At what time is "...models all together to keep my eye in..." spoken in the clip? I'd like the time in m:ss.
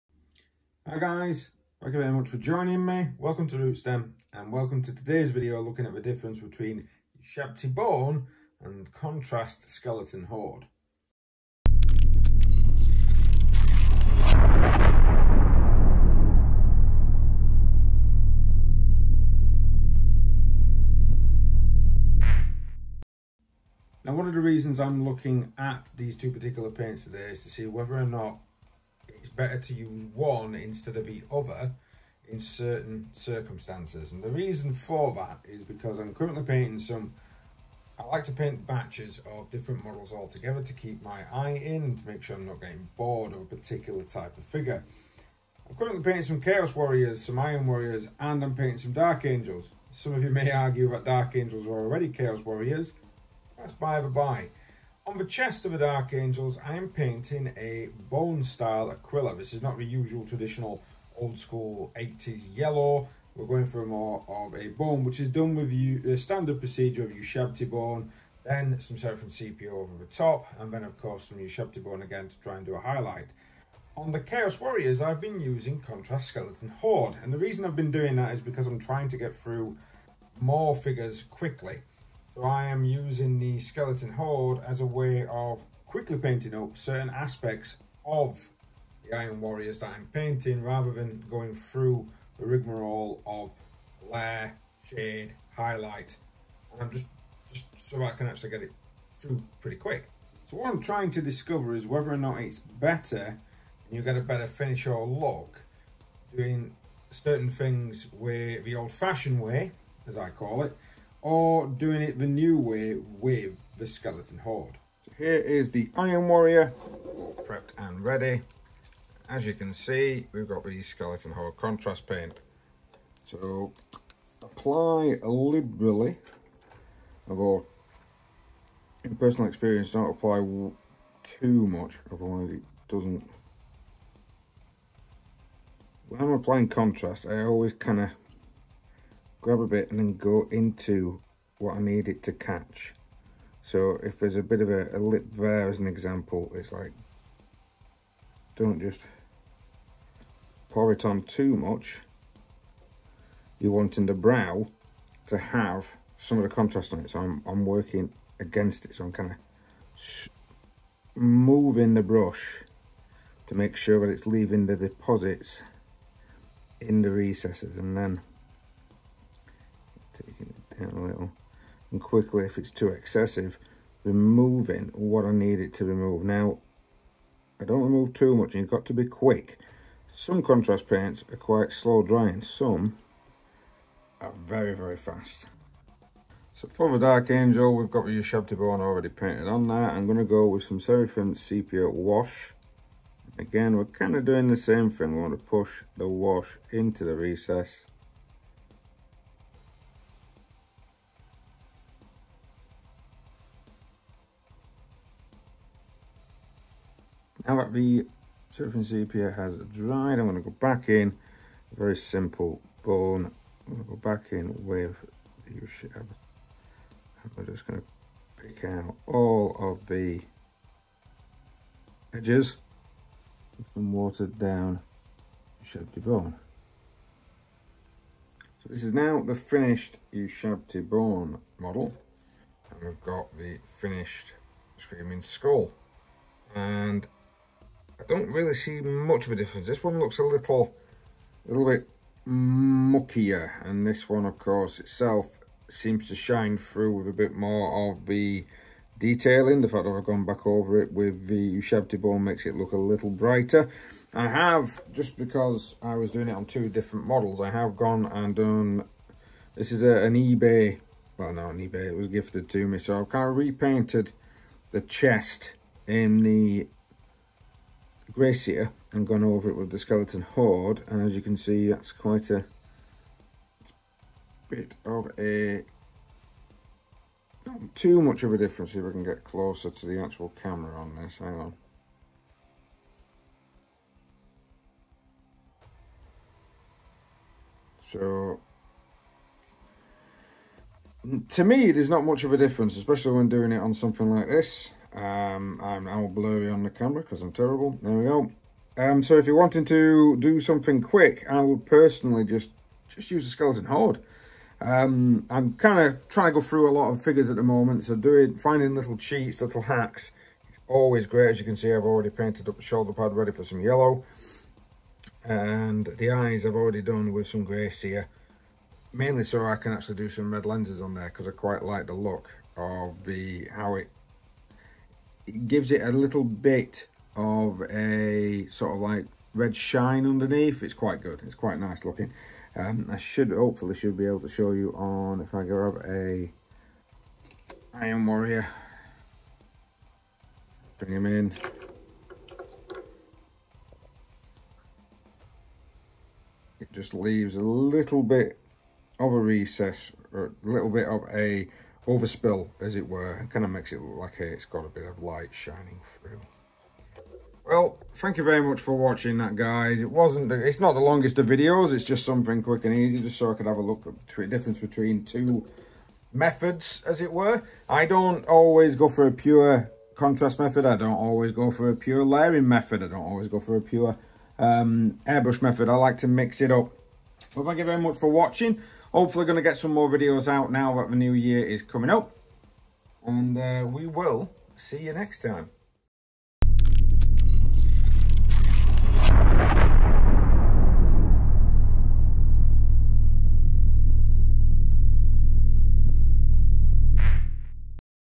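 0:39.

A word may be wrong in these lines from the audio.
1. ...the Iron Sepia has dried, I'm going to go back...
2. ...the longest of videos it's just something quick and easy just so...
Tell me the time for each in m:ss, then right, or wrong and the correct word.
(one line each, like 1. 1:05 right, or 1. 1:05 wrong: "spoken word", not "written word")
1. 3:27 wrong: "Seraphim", not "Iron"
2. 6:00 right.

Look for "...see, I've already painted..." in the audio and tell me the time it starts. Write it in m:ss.
5:11.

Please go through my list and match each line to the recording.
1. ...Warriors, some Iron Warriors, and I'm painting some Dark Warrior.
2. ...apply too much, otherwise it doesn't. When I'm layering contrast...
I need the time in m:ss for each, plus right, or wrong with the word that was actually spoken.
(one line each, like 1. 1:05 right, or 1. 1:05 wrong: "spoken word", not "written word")
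1. 0:46 wrong: "Angels", not "Warrior"
2. 2:10 wrong: "applying", not "layering".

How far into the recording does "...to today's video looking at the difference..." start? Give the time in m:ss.
0:04.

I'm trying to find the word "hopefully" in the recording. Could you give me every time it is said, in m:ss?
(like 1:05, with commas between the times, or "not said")
5:33, 6:18.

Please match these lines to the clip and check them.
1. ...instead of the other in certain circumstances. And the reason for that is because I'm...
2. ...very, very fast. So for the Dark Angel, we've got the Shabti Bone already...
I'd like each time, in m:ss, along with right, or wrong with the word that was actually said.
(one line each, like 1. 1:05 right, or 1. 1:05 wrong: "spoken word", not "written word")
1. 0:30 right
2. 3:04 right.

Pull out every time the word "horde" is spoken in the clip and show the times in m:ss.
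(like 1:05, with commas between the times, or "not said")
0:10, 1:16, 1:24, 1:54, 2:01, 4:30, 5:03.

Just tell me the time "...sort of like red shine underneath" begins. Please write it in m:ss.
5:28.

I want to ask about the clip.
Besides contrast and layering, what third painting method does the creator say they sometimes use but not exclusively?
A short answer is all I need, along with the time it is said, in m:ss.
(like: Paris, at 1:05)
Airbrush, at 6:15.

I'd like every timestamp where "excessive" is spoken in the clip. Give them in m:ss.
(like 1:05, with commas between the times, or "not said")
2:52.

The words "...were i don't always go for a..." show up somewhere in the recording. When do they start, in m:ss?
6:07.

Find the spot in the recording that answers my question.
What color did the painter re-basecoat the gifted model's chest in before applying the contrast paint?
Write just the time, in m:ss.
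4:23.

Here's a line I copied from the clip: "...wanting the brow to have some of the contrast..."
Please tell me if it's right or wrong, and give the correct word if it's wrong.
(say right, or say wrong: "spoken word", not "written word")
right.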